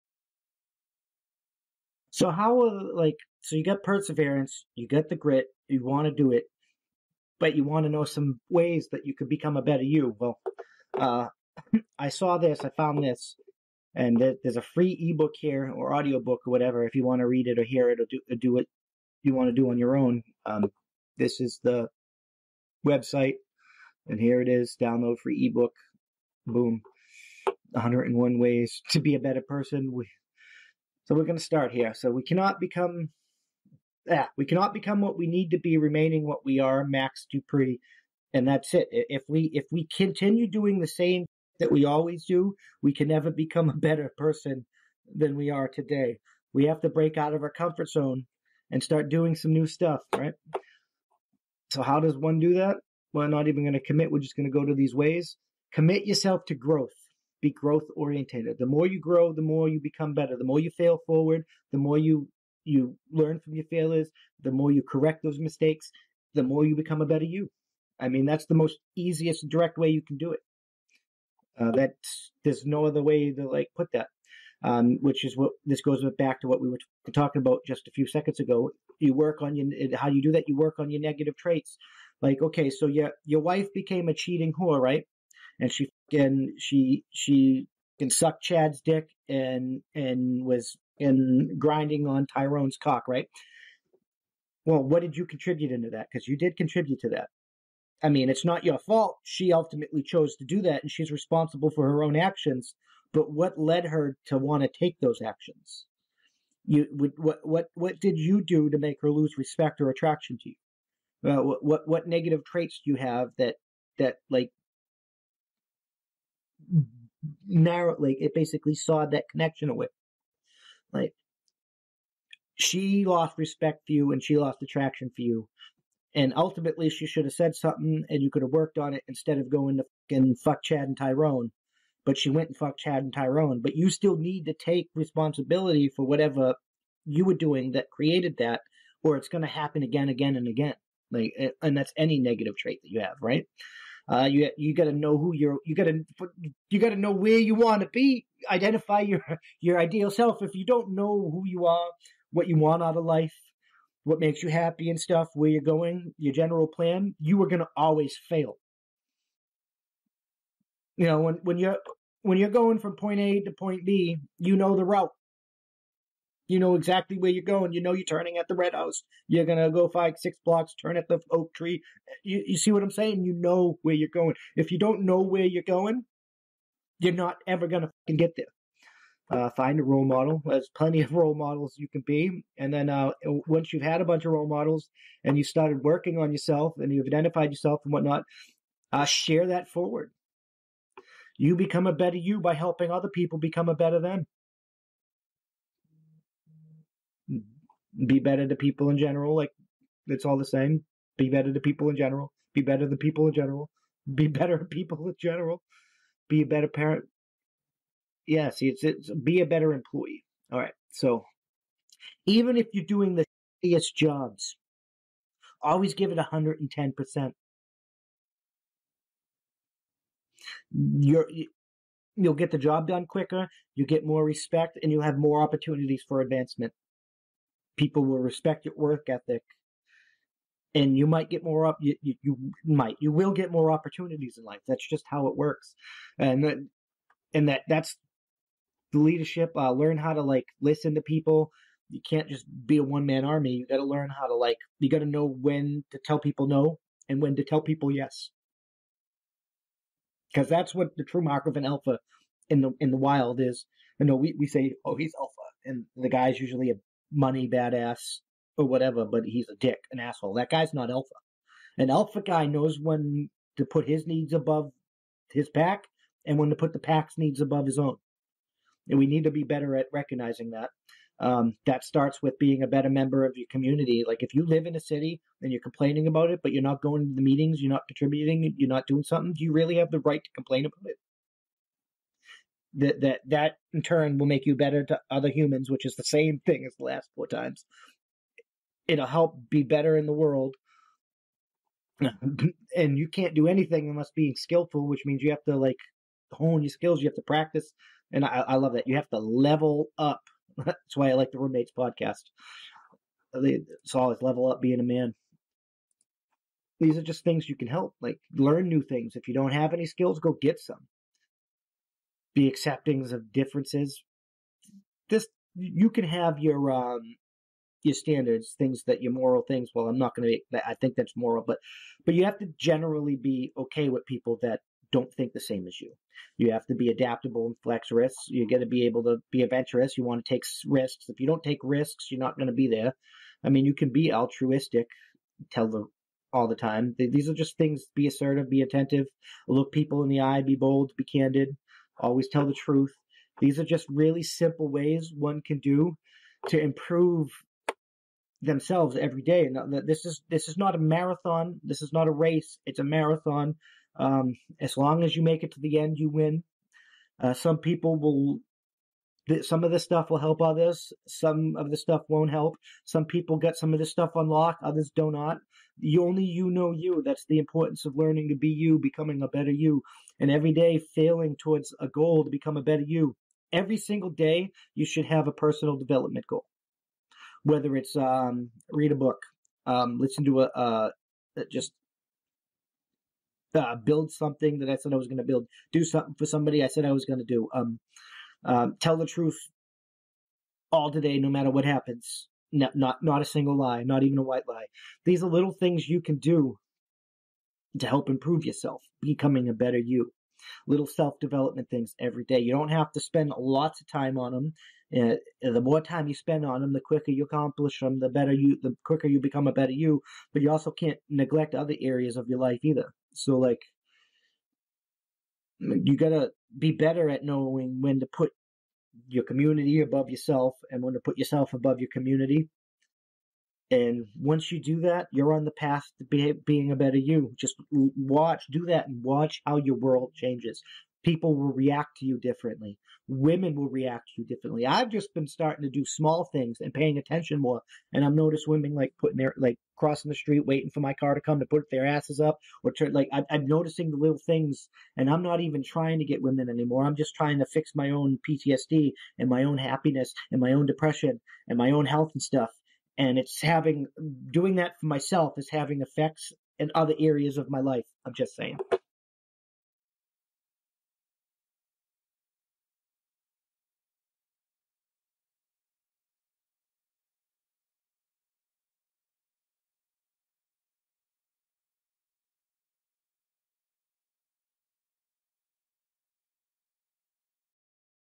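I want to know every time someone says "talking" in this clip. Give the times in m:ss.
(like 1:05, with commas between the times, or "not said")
1:17.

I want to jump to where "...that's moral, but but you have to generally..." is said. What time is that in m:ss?
5:20.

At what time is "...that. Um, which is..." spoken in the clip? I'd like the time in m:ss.
1:13.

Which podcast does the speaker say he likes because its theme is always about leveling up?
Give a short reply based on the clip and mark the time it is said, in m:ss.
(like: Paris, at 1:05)
the roommates podcast, at 5:01.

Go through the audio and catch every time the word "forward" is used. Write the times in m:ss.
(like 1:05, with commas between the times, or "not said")
1:01, 3:09.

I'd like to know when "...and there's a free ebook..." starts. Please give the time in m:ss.
0:13.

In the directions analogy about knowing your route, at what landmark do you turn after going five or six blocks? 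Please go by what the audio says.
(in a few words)
the oak tree.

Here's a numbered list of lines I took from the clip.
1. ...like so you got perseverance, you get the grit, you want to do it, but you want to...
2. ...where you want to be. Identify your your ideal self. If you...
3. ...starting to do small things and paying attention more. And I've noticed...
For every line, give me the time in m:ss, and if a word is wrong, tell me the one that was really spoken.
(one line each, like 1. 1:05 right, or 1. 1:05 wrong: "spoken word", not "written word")
1. 0:02 right
2. 2:27 right
3. 7:15 right.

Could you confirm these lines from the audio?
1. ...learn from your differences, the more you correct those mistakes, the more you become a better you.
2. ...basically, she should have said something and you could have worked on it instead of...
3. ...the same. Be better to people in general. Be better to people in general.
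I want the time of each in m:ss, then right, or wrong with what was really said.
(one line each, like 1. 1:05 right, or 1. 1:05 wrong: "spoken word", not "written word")
1. 1:03 wrong: "failures", not "differences"
2. 2:06 wrong: "ultimately", not "basically"
3. 3:20 right.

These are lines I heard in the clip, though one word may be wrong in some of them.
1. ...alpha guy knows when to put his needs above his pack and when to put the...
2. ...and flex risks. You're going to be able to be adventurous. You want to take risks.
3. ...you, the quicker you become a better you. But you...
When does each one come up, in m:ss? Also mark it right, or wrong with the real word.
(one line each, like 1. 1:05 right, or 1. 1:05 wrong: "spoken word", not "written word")
1. 4:21 right
2. 5:27 right
3. 6:48 right.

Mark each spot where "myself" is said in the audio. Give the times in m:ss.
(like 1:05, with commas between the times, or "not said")
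7:34.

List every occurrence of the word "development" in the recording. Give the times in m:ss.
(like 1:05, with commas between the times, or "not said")
6:15, 6:41.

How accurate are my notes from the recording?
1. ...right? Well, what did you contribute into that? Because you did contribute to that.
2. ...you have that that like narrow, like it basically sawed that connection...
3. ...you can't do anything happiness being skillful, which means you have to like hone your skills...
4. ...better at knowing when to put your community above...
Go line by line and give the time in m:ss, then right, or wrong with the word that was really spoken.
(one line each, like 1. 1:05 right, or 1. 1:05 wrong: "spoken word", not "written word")
1. 1:33 right
2. 1:52 right
3. 4:52 wrong: "unless", not "happiness"
4. 6:56 right.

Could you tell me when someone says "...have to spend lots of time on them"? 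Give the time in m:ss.
6:42.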